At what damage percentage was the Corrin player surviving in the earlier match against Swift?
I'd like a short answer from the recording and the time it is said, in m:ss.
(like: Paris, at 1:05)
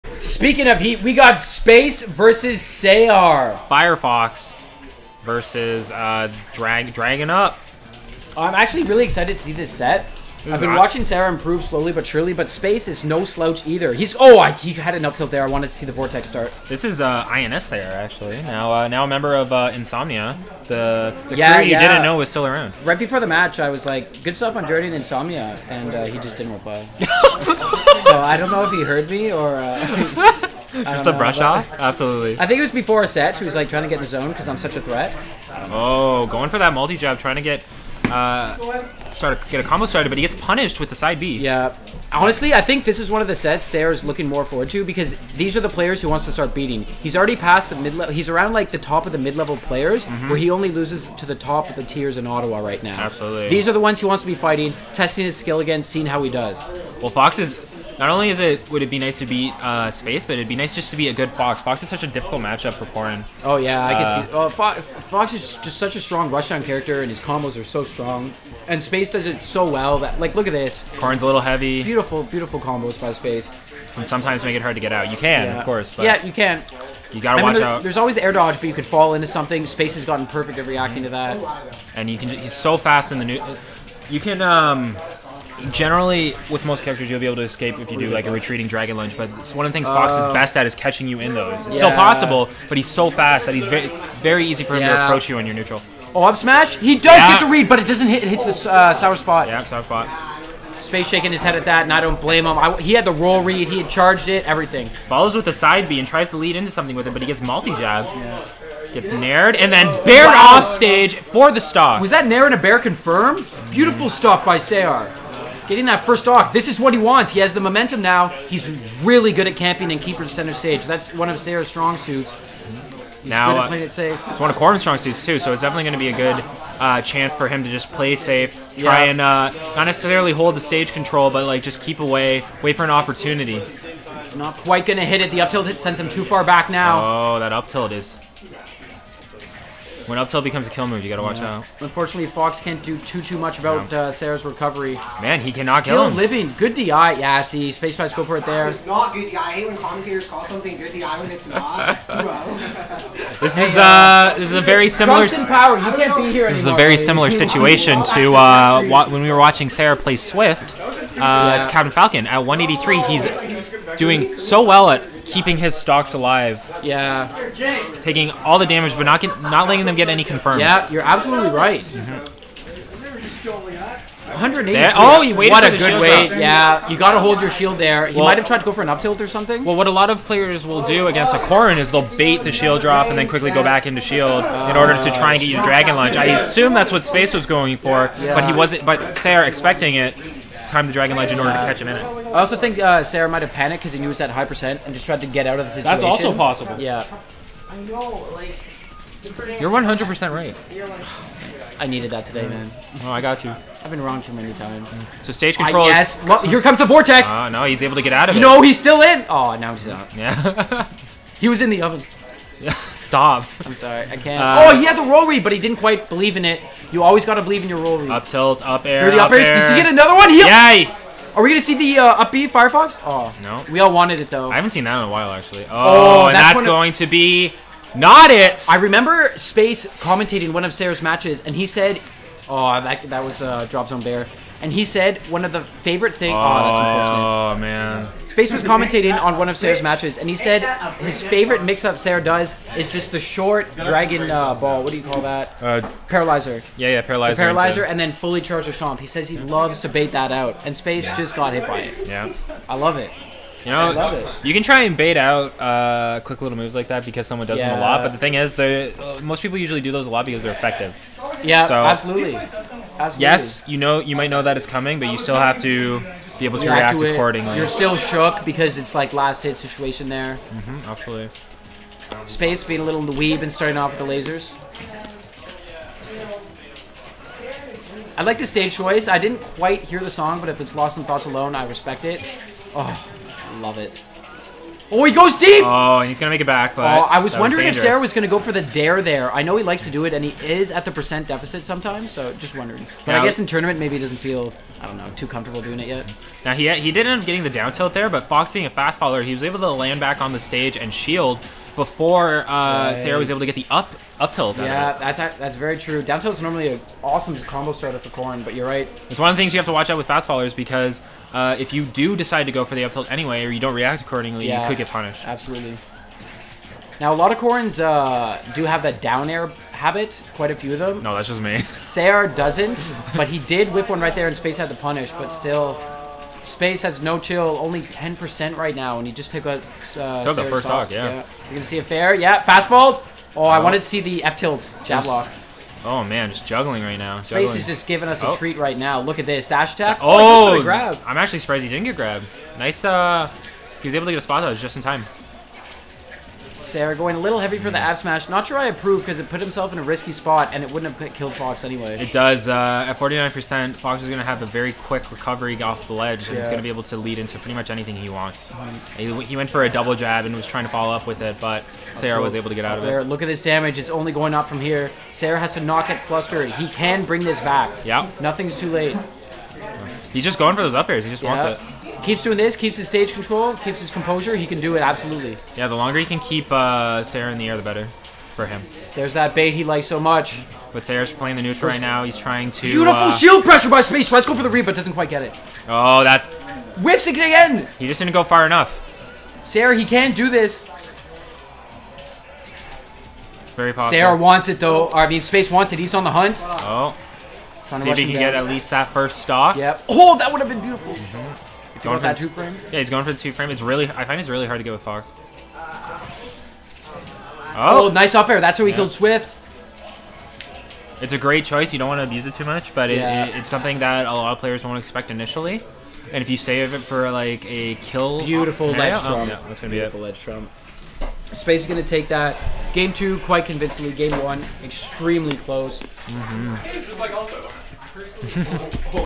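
183, at 2:42.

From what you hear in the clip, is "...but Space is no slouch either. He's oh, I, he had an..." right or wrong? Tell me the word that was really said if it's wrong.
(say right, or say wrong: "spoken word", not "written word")
right.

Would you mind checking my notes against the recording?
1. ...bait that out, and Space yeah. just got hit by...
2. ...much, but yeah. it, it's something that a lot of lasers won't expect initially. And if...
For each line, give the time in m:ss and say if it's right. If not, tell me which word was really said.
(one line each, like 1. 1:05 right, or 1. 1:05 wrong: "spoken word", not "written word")
1. 4:09 right
2. 6:52 wrong: "players", not "lasers".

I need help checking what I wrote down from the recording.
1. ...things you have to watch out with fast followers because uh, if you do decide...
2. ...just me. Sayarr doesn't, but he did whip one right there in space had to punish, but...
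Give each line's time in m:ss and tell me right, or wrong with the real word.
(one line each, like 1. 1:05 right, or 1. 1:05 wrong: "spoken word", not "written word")
1. 5:09 right
2. 5:21 right.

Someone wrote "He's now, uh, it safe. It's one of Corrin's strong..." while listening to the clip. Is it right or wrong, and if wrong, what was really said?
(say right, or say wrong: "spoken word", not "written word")
right.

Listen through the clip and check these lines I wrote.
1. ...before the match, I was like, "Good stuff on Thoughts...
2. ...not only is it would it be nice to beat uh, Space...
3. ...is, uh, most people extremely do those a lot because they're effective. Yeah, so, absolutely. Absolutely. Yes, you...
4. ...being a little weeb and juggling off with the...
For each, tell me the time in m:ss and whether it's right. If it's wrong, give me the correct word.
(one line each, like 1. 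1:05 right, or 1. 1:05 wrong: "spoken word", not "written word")
1. 0:22 wrong: "Journey", not "Thoughts"
2. 0:58 right
3. 4:18 wrong: "usually", not "extremely"
4. 4:32 wrong: "starting", not "juggling".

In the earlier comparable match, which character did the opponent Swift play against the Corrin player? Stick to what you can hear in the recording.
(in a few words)
Captain Falcon.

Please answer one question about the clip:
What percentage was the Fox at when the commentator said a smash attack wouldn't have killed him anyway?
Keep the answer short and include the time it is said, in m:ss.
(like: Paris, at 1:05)
49%, at 5:52.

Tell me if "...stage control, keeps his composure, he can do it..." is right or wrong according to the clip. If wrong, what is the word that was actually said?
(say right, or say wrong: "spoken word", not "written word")
right.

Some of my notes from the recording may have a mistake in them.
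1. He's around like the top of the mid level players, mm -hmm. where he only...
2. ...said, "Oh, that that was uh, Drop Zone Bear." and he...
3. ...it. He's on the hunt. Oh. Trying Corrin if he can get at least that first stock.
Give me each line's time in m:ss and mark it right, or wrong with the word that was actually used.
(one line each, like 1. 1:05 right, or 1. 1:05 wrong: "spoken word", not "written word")
1. 0:48 right
2. 3:51 right
3. 6:35 wrong: "See", not "Corrin".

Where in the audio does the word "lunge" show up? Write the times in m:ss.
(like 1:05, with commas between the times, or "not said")
1:28, 3:05, 3:11.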